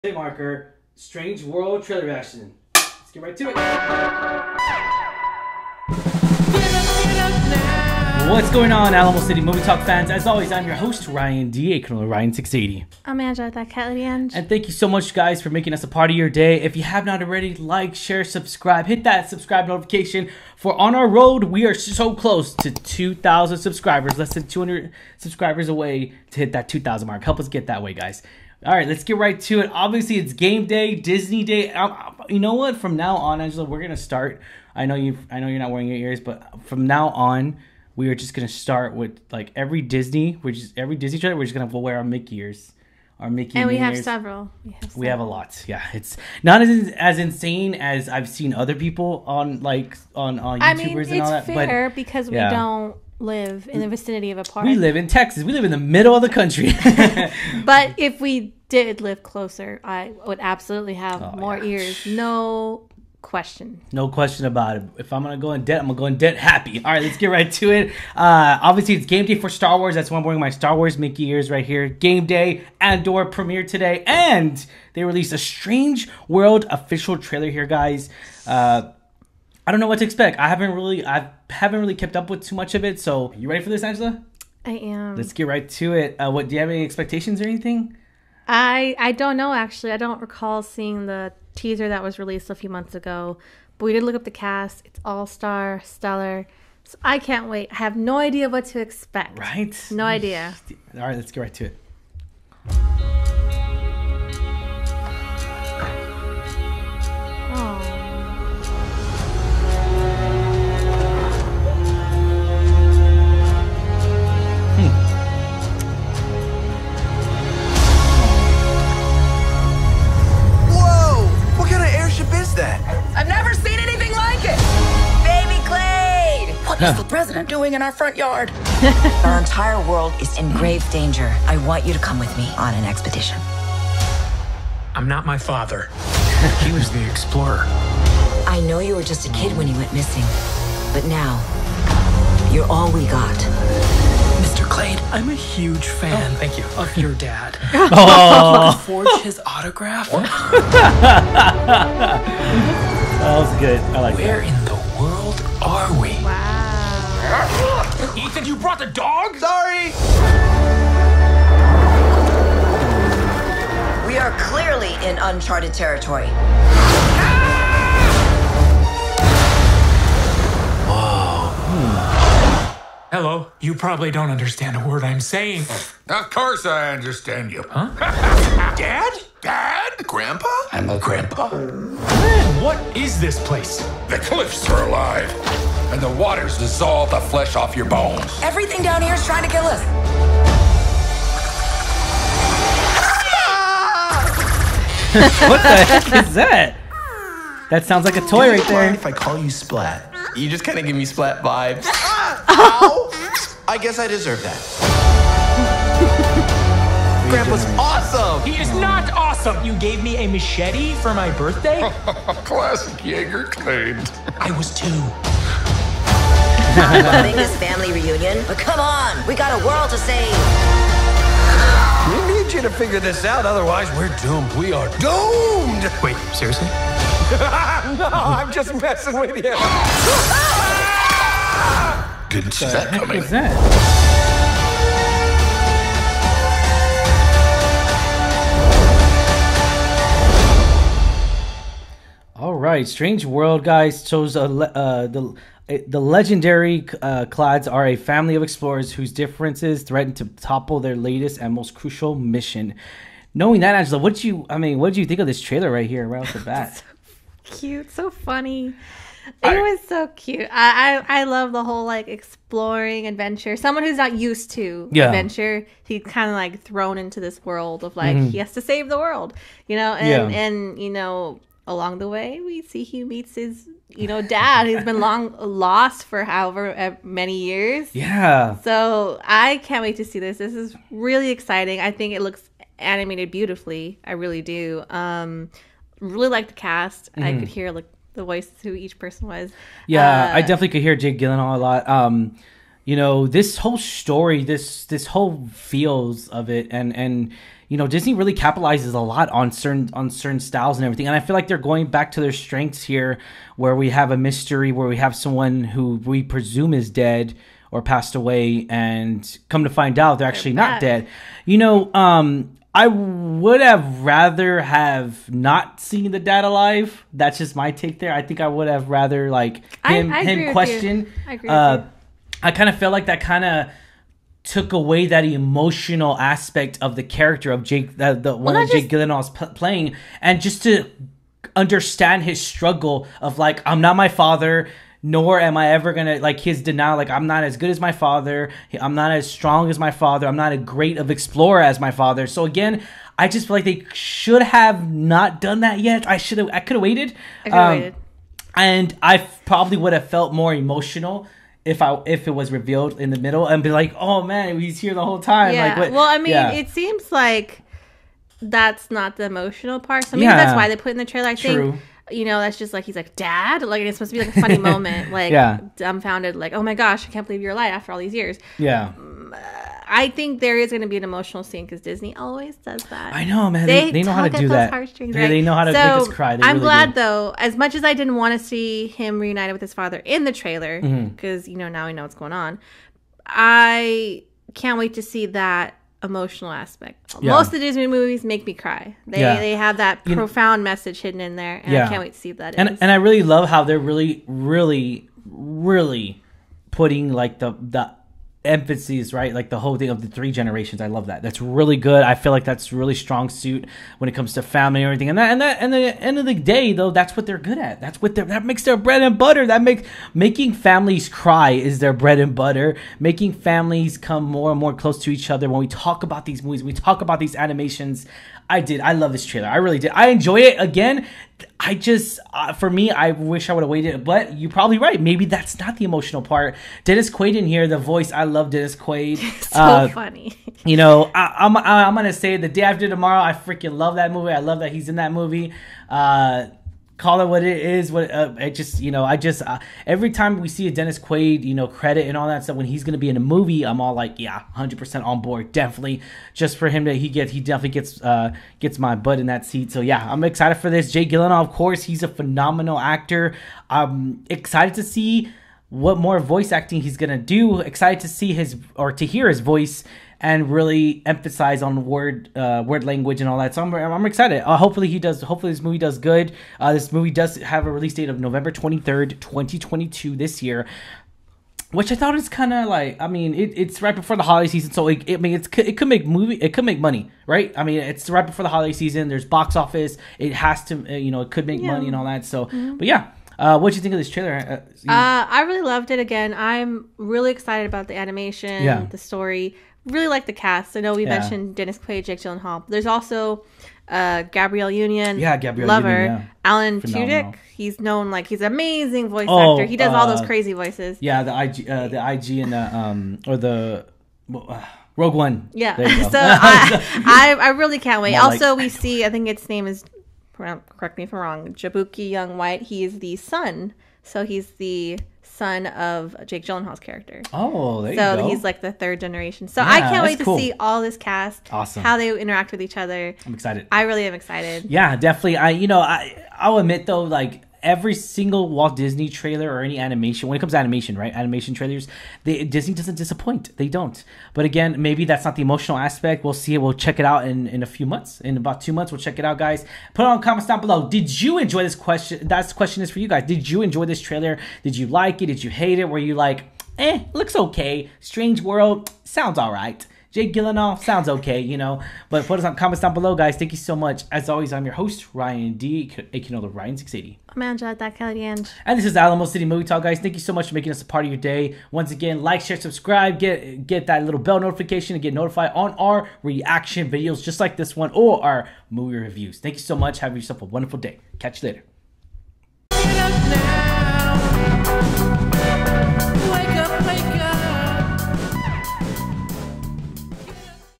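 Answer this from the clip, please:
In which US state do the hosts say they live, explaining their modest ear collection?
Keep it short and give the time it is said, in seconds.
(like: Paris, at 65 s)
Texas, at 55 s.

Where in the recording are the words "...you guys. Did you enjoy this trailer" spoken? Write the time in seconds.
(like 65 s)
542 s.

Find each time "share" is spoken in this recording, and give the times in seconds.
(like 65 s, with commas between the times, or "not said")
17 s, 562 s.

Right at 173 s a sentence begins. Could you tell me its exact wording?
You probably don't understand a word I'm saying.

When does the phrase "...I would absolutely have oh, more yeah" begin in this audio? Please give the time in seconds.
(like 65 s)
59 s.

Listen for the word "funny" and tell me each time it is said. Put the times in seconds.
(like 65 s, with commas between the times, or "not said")
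258 s, 364 s, 429 s.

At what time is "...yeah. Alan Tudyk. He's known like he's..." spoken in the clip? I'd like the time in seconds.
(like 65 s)
496 s.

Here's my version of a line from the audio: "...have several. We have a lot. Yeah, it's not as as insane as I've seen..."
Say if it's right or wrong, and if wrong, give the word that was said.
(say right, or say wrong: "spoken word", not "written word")
right.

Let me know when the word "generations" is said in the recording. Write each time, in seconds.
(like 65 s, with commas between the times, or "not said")
400 s, 518 s.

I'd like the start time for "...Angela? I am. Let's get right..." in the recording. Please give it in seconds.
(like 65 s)
83 s.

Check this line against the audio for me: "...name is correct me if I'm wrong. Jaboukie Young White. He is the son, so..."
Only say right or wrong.
right.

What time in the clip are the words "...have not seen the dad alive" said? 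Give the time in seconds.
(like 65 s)
314 s.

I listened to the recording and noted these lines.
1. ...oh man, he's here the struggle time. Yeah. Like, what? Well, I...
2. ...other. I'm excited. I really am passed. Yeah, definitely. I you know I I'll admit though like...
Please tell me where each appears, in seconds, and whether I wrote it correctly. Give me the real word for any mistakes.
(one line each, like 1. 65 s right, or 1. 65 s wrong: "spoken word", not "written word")
1. 353 s wrong: "whole", not "struggle"
2. 522 s wrong: "excited", not "passed".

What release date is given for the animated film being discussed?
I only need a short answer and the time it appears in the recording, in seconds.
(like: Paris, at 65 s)
November 23rd, 2022, at 468 s.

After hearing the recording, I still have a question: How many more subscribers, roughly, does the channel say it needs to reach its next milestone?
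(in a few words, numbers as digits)
less than 200.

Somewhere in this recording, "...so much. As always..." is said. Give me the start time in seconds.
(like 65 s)
553 s.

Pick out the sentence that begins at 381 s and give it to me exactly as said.
you know now we know what's going on.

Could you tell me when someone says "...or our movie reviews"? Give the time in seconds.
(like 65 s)
567 s.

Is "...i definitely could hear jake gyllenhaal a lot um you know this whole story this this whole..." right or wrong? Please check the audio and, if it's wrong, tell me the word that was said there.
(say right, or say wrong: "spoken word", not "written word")
right.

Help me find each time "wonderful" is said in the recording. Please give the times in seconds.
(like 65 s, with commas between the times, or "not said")
570 s.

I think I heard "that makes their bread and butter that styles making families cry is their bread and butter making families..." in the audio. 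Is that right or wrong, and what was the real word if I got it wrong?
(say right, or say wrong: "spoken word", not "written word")
wrong: "makes", not "styles".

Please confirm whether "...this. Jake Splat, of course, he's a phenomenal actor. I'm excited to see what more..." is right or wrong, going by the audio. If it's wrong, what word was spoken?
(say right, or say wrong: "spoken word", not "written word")
wrong: "Gyllenhaal", not "Splat".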